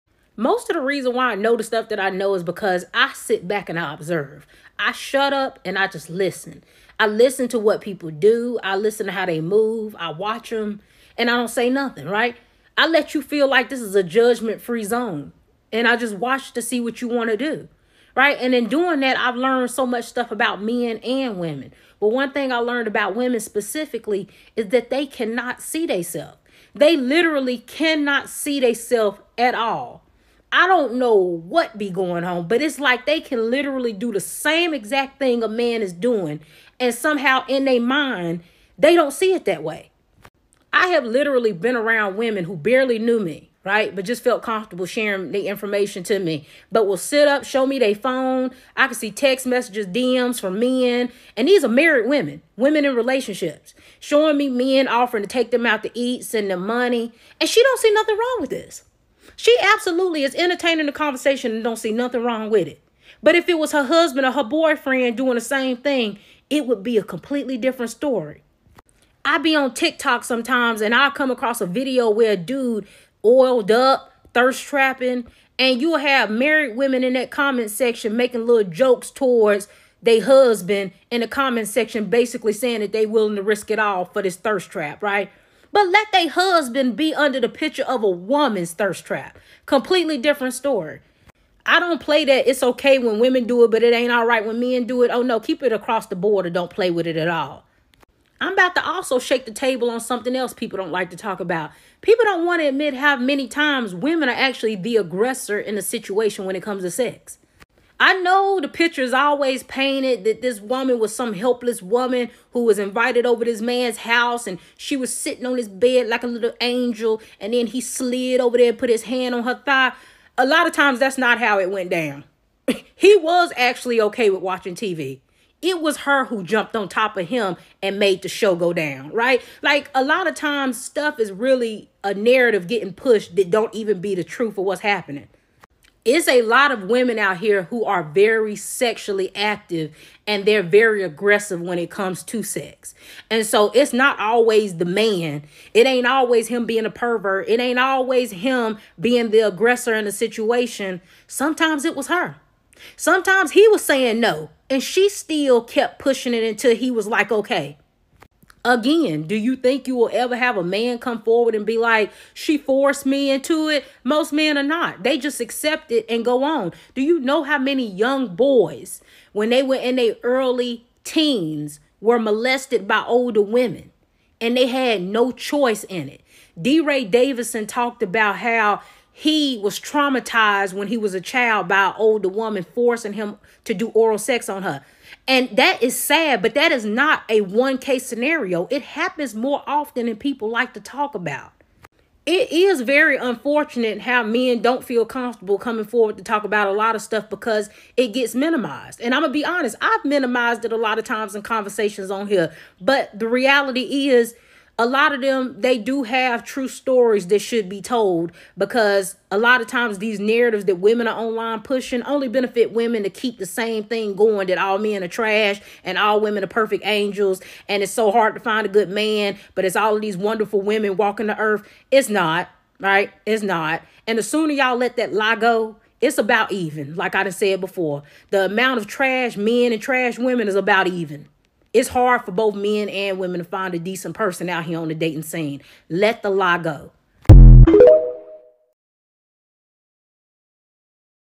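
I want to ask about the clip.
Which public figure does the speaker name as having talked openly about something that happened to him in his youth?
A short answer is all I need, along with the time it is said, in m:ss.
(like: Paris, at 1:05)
DeRay Davison, at 2:56.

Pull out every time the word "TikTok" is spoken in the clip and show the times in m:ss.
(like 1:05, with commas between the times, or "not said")
1:09.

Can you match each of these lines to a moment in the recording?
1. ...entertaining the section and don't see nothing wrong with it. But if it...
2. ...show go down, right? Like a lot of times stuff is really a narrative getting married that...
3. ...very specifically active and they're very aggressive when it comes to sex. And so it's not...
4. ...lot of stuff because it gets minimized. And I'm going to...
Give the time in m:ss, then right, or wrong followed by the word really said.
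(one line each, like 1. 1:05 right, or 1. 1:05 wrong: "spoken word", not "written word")
1. 1:00 wrong: "conversation", not "section"
2. 2:08 wrong: "pushed", not "married"
3. 2:18 wrong: "sexually", not "specifically"
4. 3:16 right.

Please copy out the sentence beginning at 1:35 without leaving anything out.
Oh no, keep it across the board or don't play with it at all.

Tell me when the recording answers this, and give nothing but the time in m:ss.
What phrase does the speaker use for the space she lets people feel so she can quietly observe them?
0:14.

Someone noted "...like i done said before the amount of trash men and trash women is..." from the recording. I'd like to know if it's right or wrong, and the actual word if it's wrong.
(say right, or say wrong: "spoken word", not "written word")
right.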